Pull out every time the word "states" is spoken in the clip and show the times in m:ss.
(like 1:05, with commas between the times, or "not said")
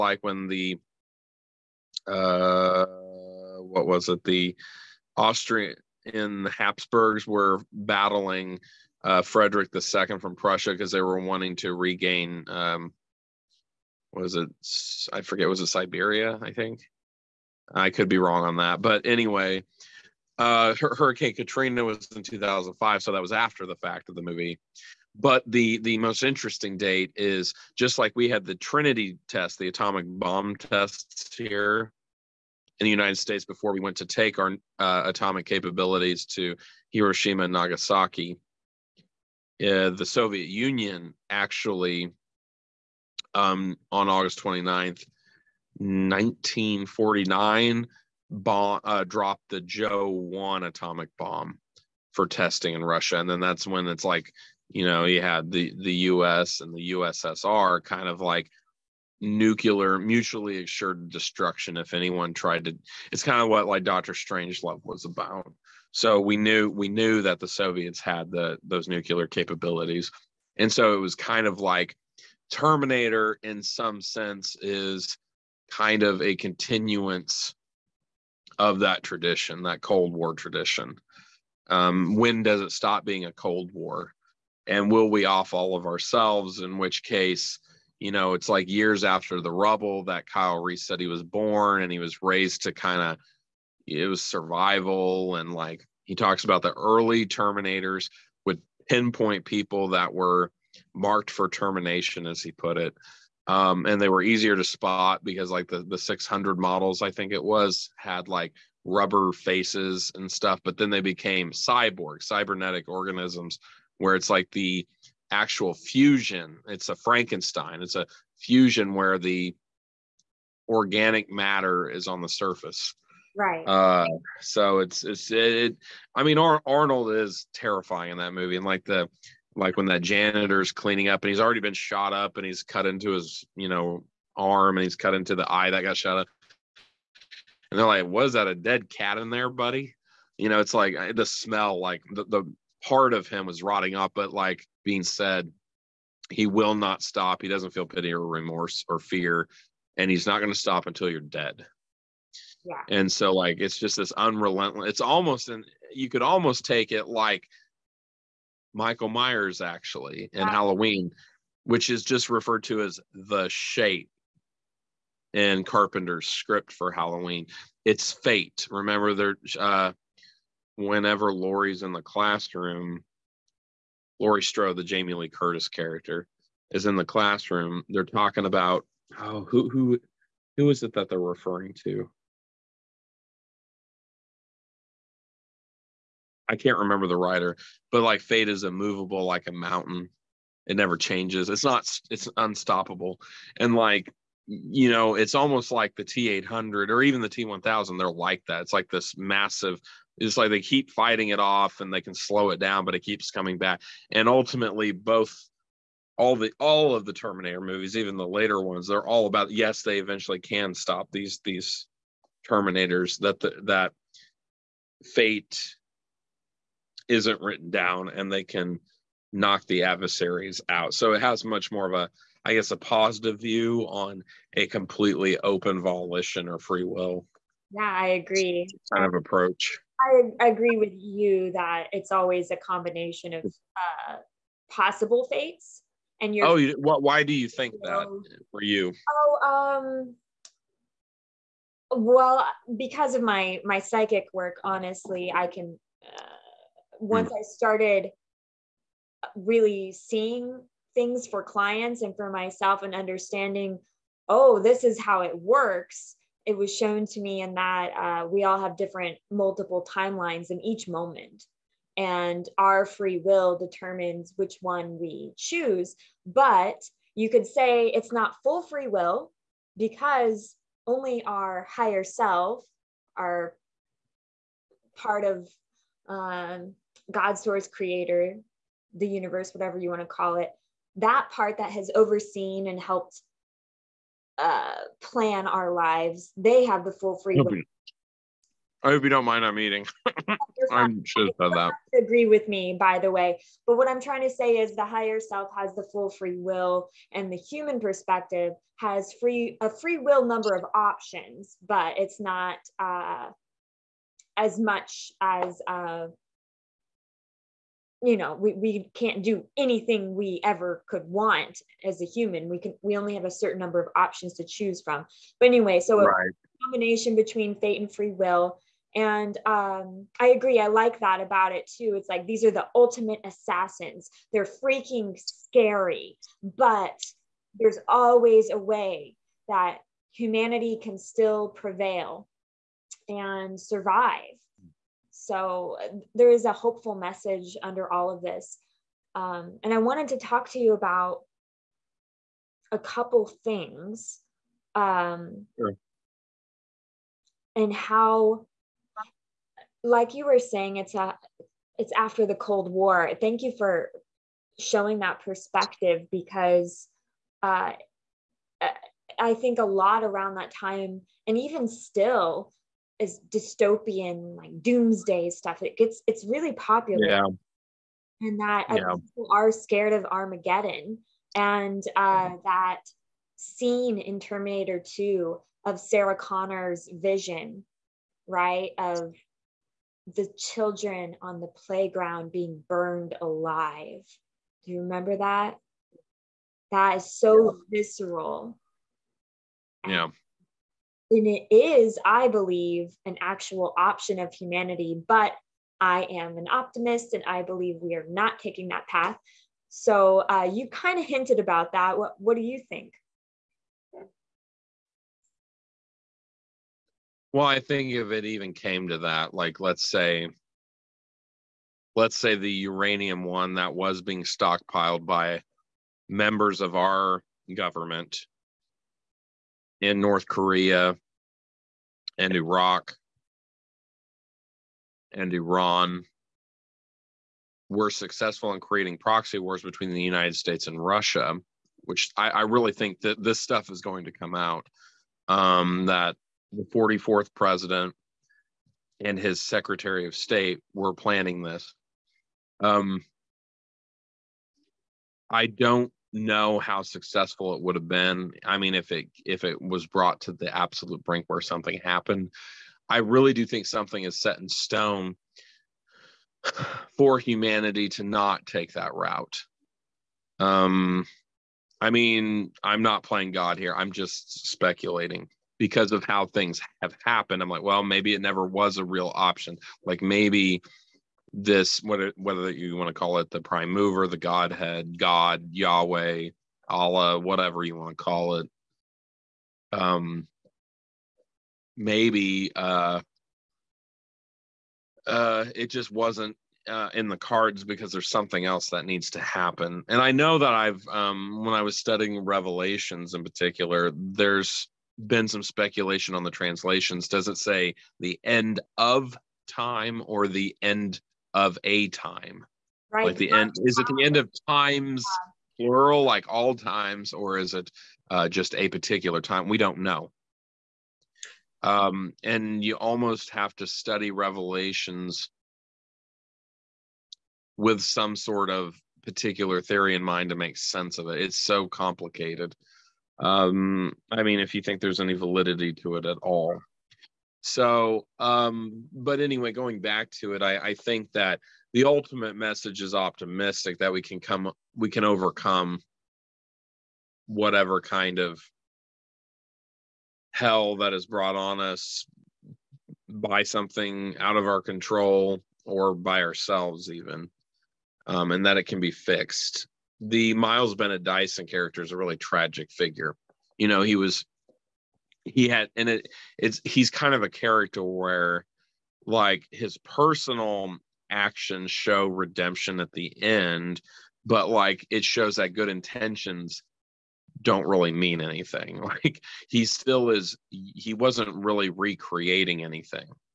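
0:33, 7:10, 7:20.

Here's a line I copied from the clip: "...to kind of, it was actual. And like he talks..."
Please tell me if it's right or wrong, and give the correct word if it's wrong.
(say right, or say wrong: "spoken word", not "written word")
wrong: "survival", not "actual".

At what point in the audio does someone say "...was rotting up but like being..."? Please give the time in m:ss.
2:23.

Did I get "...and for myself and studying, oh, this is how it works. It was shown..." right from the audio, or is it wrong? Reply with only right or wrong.
wrong.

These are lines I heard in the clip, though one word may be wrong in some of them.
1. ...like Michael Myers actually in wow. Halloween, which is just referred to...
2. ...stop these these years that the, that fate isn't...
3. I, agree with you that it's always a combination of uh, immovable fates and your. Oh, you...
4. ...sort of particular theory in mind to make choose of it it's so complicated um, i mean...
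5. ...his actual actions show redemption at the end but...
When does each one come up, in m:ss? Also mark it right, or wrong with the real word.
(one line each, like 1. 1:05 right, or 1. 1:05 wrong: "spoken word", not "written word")
1. 2:37 right
2. 3:30 wrong: "terminators", not "years"
3. 3:50 wrong: "possible", not "immovable"
4. 8:38 wrong: "sense", not "choose"
5. 9:19 wrong: "personal", not "actual".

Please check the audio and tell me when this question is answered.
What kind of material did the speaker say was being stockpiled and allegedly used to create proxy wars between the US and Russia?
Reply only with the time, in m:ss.
6:52.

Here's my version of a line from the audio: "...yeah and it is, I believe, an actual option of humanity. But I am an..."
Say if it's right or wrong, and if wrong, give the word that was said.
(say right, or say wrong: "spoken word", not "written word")
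right.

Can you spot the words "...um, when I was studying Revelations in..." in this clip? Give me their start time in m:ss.
8:10.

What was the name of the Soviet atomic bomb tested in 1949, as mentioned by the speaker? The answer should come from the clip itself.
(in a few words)
Joe One.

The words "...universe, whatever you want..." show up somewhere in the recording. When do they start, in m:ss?
4:39.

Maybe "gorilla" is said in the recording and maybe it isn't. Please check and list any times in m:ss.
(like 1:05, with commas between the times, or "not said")
not said.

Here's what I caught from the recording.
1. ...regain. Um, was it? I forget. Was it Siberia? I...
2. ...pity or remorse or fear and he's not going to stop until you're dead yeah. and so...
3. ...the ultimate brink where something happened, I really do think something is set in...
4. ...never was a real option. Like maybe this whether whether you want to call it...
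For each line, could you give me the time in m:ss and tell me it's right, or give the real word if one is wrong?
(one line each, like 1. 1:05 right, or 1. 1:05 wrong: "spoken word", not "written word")
1. 0:11 right
2. 2:27 right
3. 7:30 wrong: "absolute", not "ultimate"
4. 7:48 right.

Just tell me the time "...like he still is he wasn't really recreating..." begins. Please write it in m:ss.
9:28.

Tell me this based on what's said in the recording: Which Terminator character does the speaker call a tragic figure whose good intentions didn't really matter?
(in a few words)
Miles Bennett Dyson.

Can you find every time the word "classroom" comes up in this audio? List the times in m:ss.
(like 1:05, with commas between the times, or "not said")
2:52, 2:57.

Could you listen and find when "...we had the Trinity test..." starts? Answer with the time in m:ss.
0:28.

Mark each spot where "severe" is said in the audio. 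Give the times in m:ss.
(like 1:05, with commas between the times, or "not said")
not said.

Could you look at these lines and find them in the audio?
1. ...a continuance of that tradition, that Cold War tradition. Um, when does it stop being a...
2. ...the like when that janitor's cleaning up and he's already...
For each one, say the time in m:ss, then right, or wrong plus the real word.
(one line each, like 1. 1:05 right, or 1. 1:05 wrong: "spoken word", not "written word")
1. 1:16 right
2. 2:08 right.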